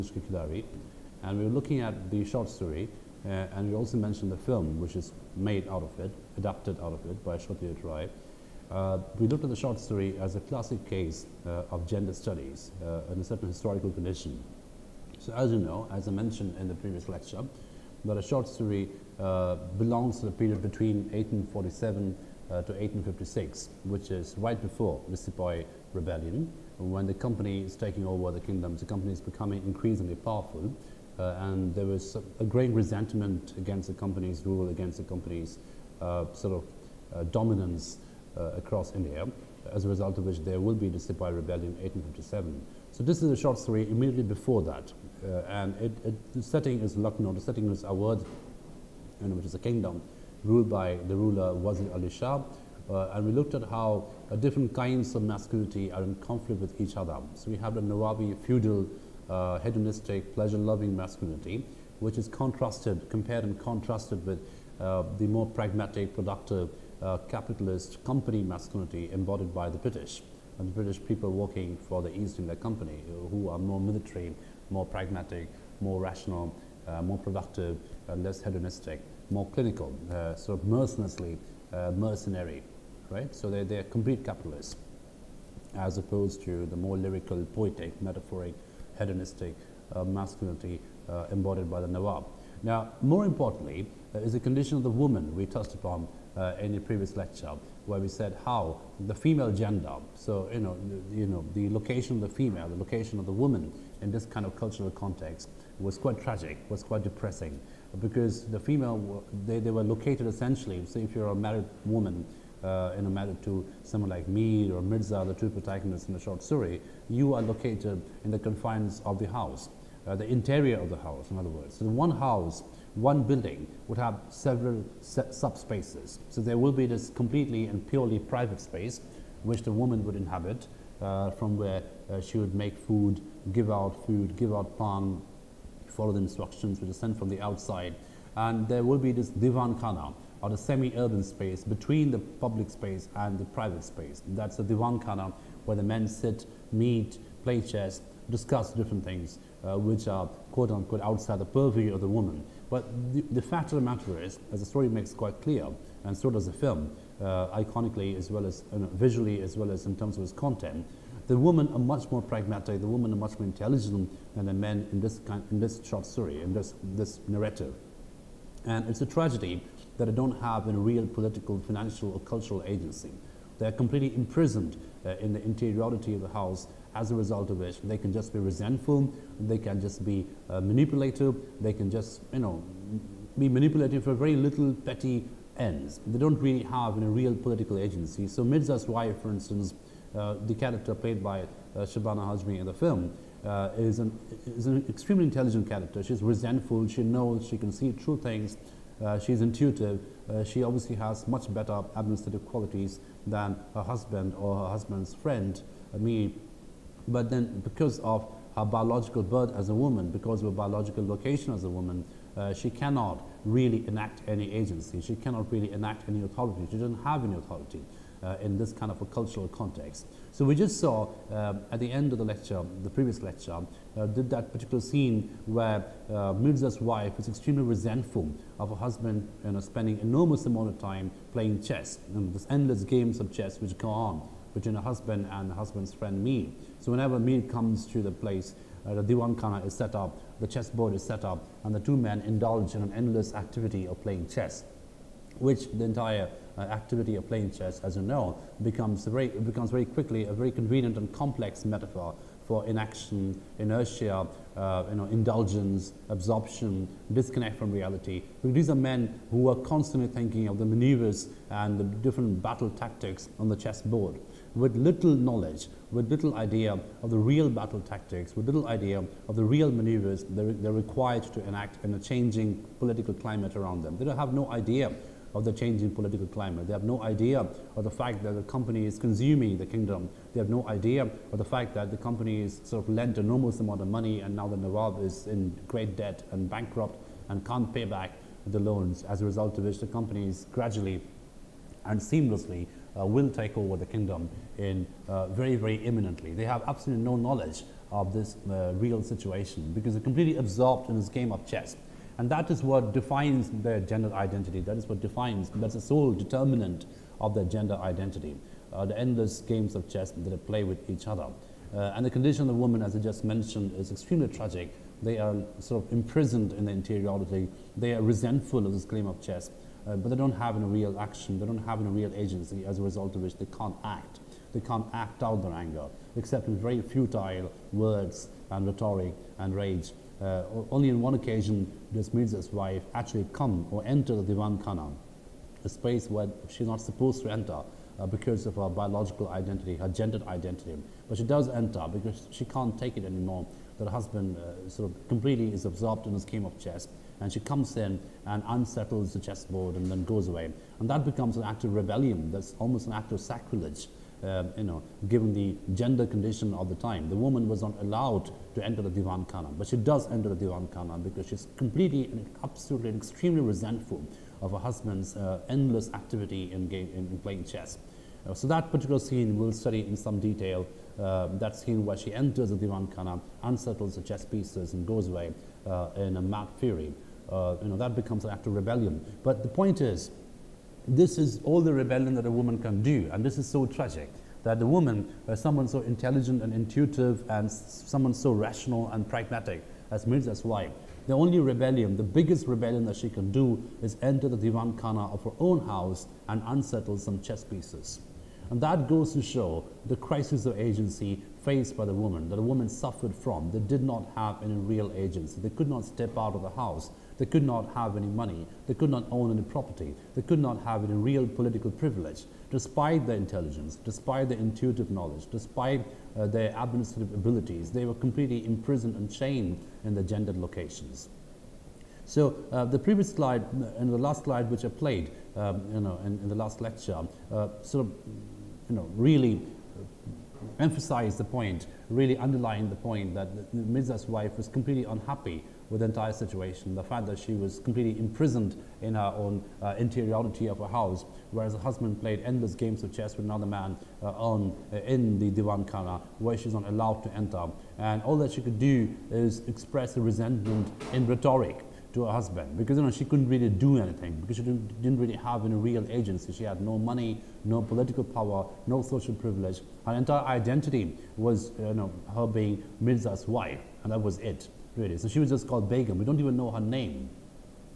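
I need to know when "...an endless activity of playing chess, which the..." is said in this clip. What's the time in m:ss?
4:02.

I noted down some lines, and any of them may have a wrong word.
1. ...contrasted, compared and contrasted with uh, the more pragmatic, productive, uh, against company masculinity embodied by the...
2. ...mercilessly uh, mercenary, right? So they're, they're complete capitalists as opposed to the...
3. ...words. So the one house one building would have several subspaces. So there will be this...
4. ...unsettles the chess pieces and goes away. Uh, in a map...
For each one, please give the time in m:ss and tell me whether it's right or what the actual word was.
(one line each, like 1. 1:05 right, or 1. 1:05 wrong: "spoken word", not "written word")
1. 1:02 wrong: "capitalist", not "against"
2. 1:20 right
3. 2:01 right
4. 6:13 right.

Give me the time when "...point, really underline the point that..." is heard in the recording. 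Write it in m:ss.
7:11.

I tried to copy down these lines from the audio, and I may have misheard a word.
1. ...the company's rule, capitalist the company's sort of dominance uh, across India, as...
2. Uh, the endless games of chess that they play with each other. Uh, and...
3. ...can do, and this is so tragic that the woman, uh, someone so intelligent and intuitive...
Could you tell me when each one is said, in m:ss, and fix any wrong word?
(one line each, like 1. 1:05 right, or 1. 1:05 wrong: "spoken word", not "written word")
1. 0:33 wrong: "against", not "capitalist"
2. 5:08 right
3. 6:22 right.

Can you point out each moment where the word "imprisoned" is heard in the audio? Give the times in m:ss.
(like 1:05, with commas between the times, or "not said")
2:54, 5:15, 6:58, 7:17.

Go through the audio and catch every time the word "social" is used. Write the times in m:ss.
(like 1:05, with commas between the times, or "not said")
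7:38.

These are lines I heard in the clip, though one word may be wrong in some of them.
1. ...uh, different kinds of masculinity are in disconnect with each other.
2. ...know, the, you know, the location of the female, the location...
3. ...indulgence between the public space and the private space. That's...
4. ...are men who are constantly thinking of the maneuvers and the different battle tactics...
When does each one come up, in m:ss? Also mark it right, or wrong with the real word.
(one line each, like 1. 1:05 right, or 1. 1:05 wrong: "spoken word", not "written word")
1. 0:54 wrong: "conflict", not "disconnect"
2. 1:40 right
3. 2:21 wrong: "space", not "indulgence"
4. 4:18 right.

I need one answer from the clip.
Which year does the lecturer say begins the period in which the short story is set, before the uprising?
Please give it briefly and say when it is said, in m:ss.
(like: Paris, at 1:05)
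1847, at 0:21.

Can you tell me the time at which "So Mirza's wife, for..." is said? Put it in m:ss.
3:08.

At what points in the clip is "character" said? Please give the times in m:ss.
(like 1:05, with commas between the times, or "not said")
3:10, 3:15.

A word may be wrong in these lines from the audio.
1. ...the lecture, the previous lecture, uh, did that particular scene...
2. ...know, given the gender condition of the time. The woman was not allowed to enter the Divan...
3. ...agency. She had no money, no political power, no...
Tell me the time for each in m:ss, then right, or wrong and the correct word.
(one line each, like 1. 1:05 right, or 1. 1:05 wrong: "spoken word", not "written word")
1. 3:42 right
2. 5:54 right
3. 7:35 right.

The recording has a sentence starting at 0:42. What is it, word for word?
So this is a short story immediately before that.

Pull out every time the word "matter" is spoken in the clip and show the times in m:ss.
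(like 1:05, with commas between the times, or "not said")
1:53, 2:33.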